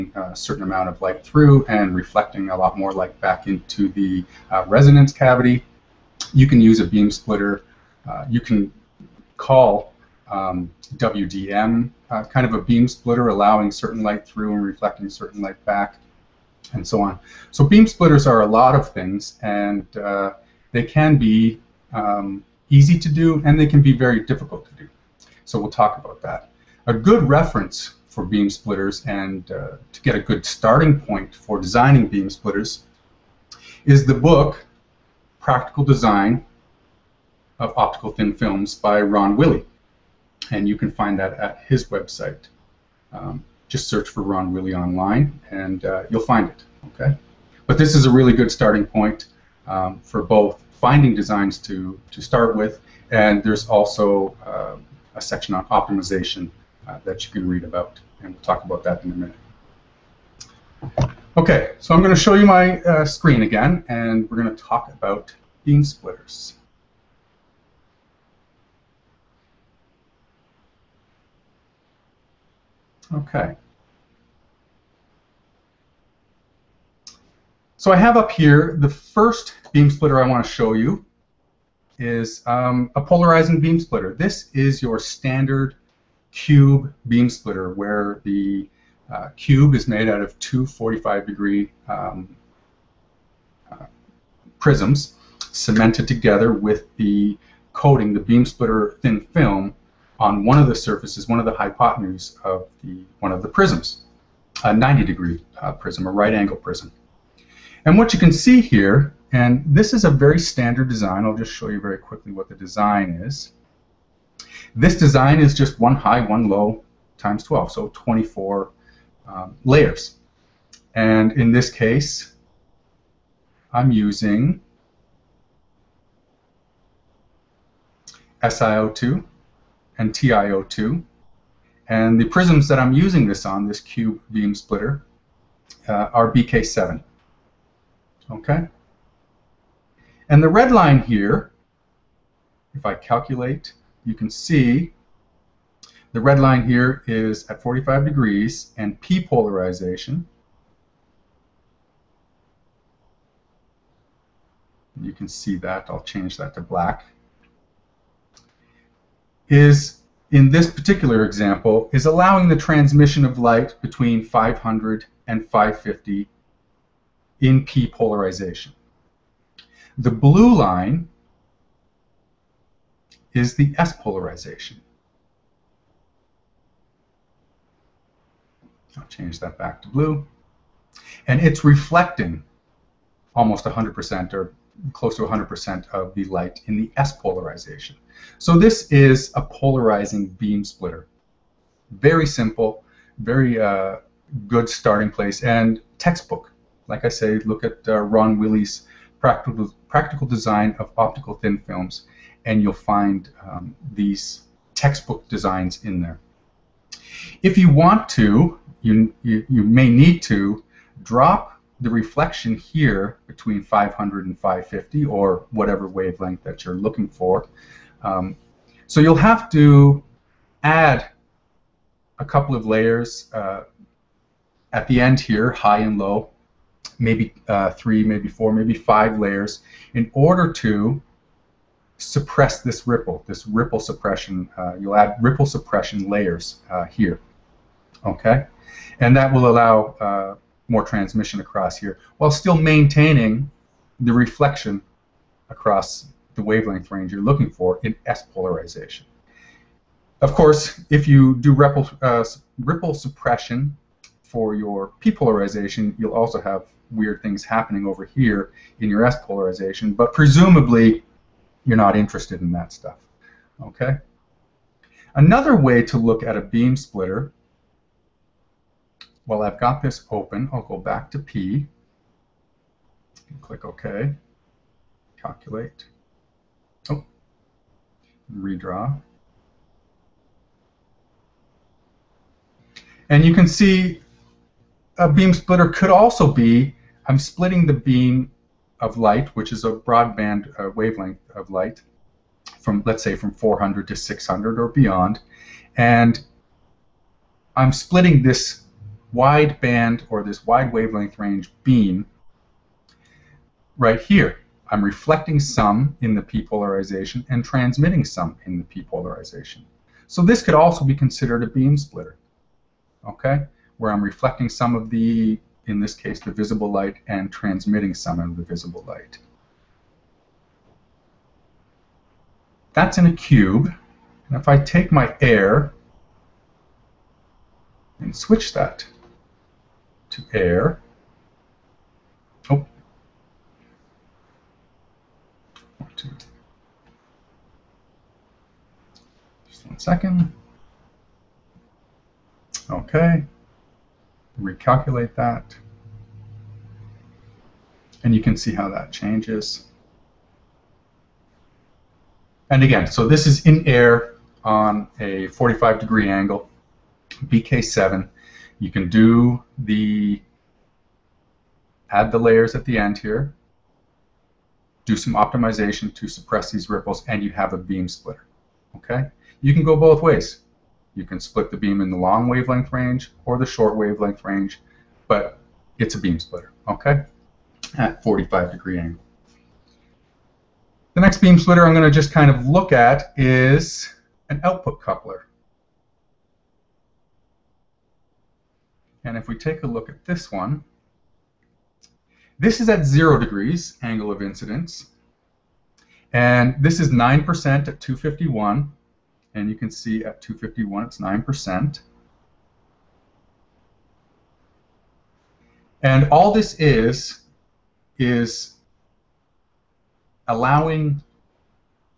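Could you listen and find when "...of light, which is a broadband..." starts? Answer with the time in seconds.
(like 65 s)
288 s.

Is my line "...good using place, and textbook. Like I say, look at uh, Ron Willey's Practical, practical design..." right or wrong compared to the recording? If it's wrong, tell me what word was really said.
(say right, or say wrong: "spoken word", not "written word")
wrong: "starting", not "using".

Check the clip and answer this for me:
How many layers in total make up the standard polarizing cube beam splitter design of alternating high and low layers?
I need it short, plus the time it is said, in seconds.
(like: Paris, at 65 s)
24, at 117 s.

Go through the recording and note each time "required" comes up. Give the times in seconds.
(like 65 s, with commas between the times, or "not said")
not said.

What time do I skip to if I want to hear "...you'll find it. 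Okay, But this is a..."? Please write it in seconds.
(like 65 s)
46 s.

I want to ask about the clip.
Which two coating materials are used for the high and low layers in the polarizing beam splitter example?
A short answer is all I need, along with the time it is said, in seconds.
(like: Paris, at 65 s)
SiO2 and TiO2, at 128 s.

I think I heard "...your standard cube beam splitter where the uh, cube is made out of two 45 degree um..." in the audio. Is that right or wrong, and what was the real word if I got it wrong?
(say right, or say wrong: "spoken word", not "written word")
right.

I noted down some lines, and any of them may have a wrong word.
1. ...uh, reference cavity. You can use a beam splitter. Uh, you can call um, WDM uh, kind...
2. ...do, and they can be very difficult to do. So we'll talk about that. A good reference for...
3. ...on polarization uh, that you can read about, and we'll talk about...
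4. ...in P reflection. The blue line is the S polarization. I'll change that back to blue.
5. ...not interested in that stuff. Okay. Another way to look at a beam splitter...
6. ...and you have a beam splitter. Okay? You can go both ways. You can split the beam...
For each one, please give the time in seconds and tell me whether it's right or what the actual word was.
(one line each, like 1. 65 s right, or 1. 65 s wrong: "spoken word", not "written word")
1. 4 s wrong: "resonance", not "reference"
2. 23 s right
3. 55 s wrong: "optimization", not "polarization"
4. 167 s wrong: "polarization", not "reflection"
5. 261 s right
6. 367 s right.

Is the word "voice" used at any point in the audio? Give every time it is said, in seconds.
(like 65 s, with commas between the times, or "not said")
not said.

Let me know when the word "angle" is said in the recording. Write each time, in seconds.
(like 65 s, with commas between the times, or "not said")
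106 s, 356 s, 378 s, 393 s.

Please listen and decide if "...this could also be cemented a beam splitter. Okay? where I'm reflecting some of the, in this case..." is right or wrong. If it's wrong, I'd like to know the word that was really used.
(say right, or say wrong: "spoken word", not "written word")
wrong: "considered", not "cemented".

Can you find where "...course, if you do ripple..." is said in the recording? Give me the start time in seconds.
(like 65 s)
250 s.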